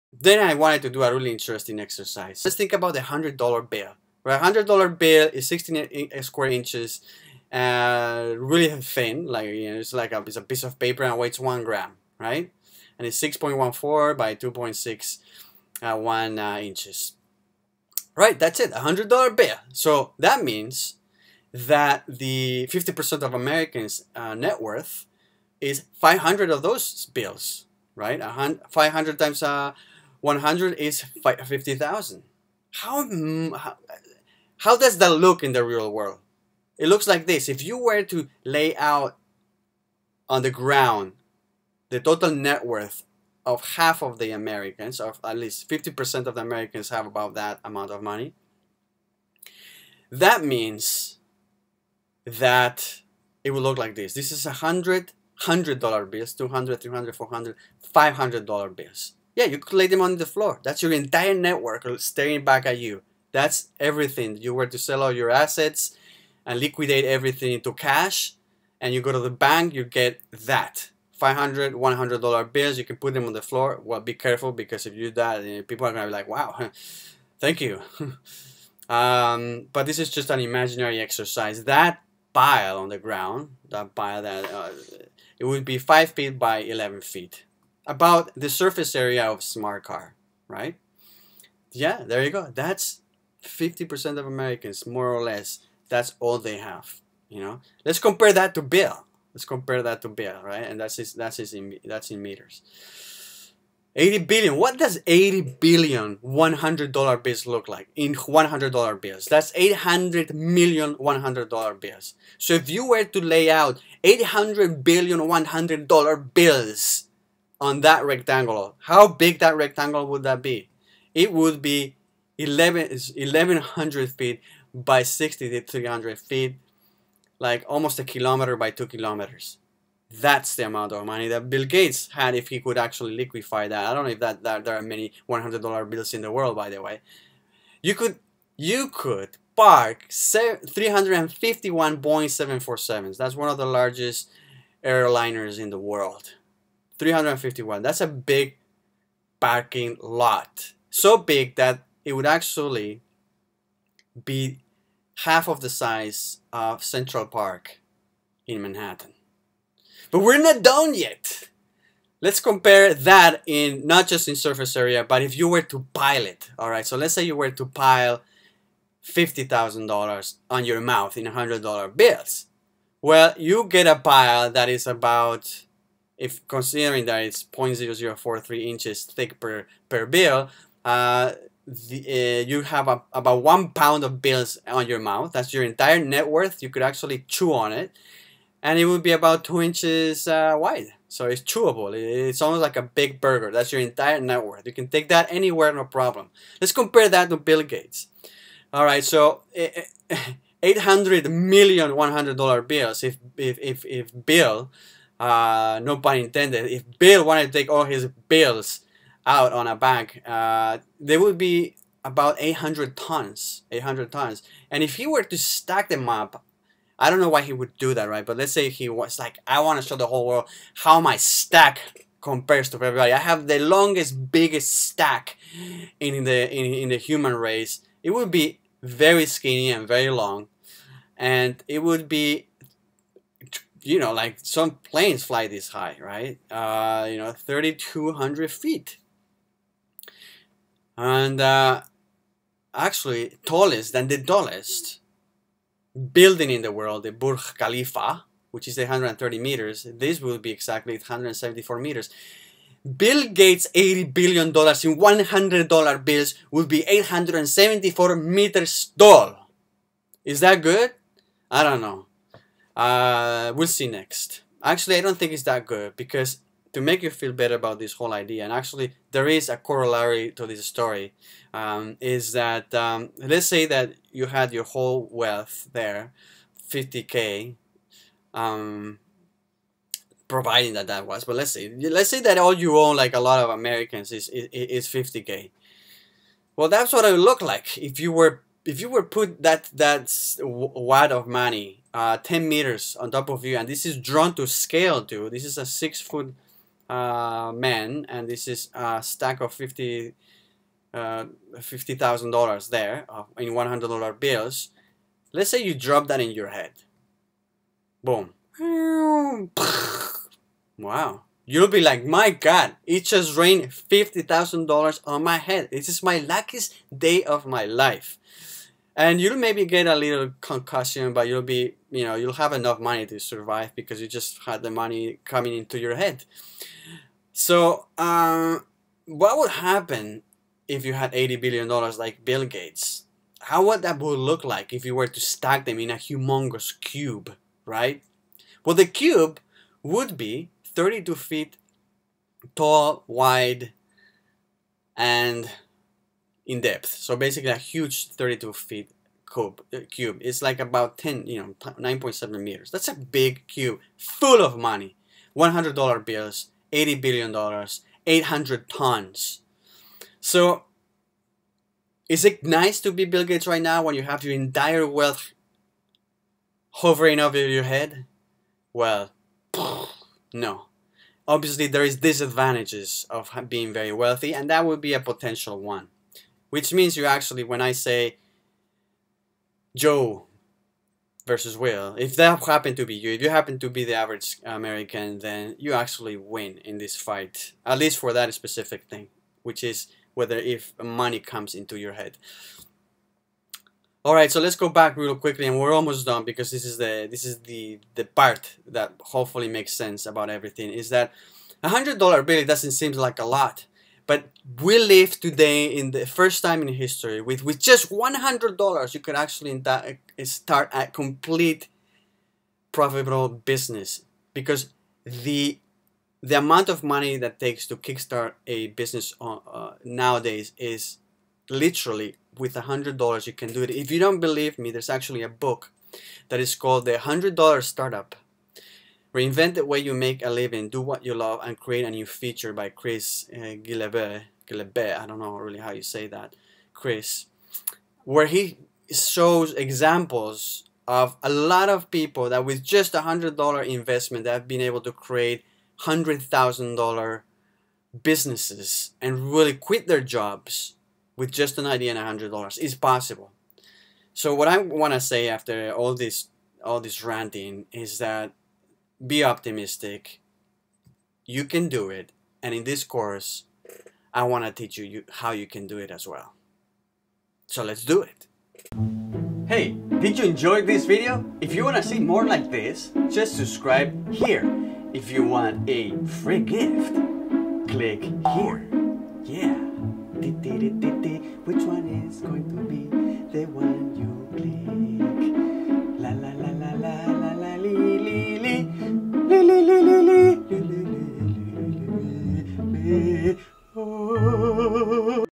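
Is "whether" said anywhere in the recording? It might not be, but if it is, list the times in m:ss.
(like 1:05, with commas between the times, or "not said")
6:30.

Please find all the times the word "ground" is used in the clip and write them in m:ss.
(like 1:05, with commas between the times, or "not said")
0:40, 1:22.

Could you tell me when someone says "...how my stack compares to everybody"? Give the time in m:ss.
3:40.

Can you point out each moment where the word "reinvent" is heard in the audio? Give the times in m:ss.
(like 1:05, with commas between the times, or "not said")
7:09.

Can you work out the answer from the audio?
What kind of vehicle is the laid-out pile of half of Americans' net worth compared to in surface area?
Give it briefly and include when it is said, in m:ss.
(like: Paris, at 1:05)
smart car, at 1:29.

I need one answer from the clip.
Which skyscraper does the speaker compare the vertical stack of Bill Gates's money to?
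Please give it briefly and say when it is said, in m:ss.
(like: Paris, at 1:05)
Burj Khalifa, at 4:07.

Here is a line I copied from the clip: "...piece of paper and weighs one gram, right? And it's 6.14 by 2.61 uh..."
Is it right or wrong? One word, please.
right.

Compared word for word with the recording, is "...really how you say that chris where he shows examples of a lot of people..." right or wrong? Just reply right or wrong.
right.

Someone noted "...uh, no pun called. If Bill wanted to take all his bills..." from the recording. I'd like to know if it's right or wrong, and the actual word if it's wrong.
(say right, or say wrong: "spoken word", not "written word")
wrong: "intended", not "called".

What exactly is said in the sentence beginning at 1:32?
That's 50% of Americans, more or less.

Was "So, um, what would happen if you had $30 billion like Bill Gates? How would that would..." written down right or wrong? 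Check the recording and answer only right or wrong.
wrong.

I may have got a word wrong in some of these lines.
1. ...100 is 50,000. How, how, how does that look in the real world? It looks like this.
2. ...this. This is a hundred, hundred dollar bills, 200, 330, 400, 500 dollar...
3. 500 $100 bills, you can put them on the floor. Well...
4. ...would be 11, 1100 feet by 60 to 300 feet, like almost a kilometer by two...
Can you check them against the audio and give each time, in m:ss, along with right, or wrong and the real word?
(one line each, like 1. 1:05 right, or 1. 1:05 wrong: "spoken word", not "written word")
1. 0:30 right
2. 0:53 wrong: "300", not "330"
3. 1:11 right
4. 2:01 right.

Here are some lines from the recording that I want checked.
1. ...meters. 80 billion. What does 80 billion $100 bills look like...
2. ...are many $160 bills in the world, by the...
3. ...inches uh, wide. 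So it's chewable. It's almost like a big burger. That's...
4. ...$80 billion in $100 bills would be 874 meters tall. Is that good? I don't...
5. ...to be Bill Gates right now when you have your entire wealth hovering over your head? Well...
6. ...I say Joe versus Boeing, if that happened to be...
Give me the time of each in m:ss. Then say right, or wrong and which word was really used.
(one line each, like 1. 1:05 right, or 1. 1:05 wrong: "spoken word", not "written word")
1. 1:42 right
2. 2:14 wrong: "100", not "160"
3. 3:09 right
4. 4:13 right
5. 6:02 right
6. 6:17 wrong: "Will", not "Boeing".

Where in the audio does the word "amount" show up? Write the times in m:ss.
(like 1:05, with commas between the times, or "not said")
0:47, 2:10, 6:56.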